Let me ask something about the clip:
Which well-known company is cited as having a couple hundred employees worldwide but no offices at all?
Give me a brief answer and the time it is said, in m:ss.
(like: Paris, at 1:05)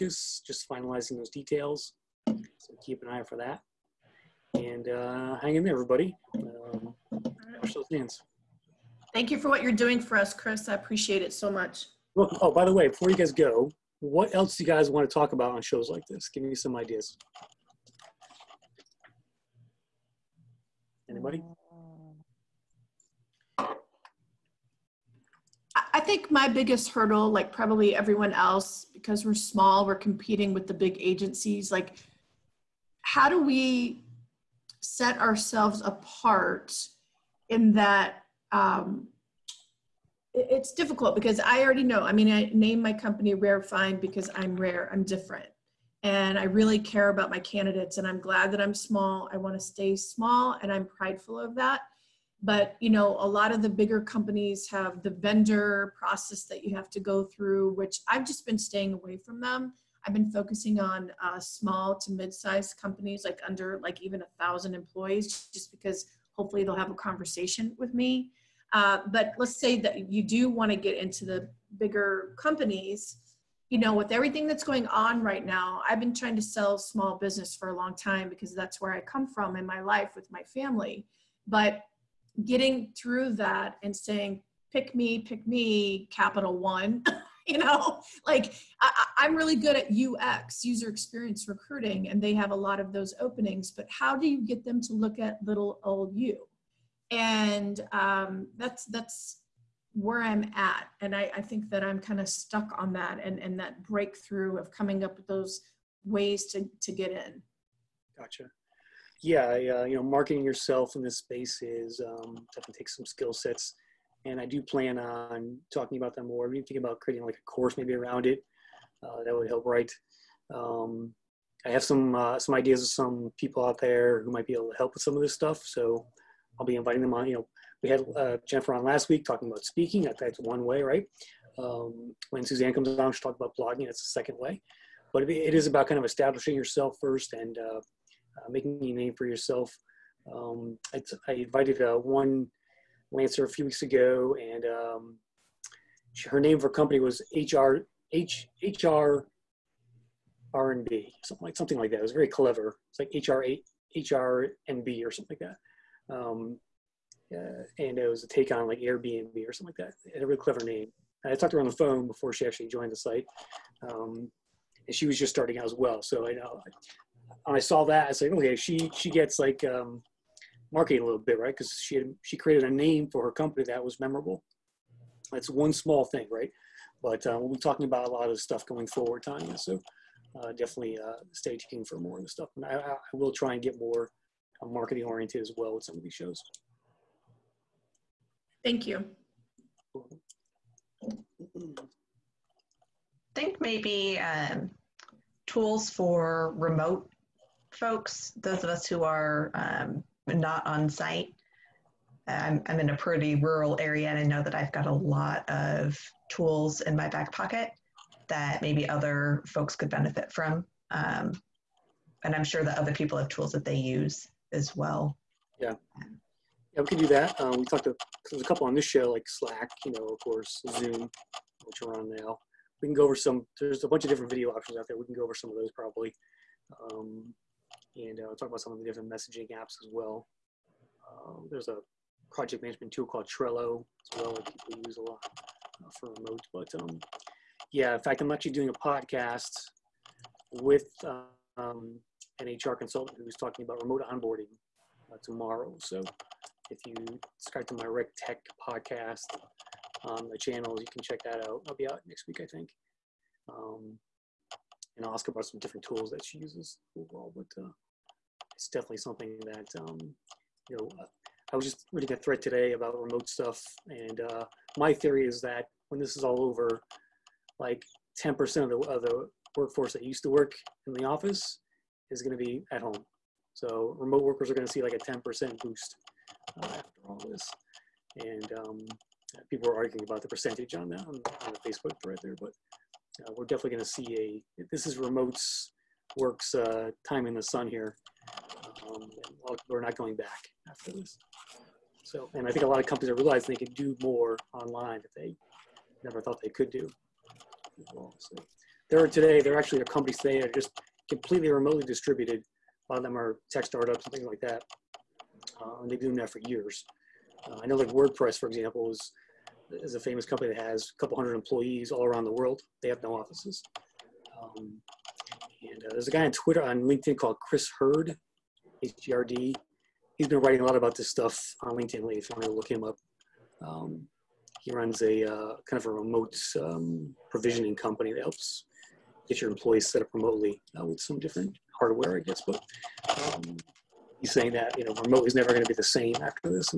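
WordPress, at 5:07.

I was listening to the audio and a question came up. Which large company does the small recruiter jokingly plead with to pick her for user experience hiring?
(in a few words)
Capital One.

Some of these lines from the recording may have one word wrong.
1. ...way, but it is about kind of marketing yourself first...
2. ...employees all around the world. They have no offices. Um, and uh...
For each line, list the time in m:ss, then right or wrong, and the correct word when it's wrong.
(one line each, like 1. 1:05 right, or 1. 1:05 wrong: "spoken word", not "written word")
1. 2:14 wrong: "establishing", not "marketing"
2. 5:11 right.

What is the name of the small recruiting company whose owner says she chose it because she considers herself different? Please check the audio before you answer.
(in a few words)
Rare Find.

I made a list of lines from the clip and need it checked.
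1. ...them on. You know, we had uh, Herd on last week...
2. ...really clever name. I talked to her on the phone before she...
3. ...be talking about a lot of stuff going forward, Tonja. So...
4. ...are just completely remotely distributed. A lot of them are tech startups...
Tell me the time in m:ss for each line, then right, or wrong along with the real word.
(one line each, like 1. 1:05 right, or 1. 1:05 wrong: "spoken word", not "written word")
1. 2:07 wrong: "Jennifer", not "Herd"
2. 2:40 right
3. 2:57 right
4. 5:00 right.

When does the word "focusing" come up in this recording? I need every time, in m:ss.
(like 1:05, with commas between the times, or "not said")
1:00.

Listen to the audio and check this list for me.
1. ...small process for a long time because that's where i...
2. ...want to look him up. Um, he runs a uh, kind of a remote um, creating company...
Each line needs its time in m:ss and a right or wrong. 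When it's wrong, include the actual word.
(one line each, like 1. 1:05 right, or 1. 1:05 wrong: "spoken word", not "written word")
1. 1:16 wrong: "business", not "process"
2. 5:22 wrong: "provisioning", not "creating".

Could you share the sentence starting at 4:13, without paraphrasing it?
Um, and ask about some different tools that she uses overall.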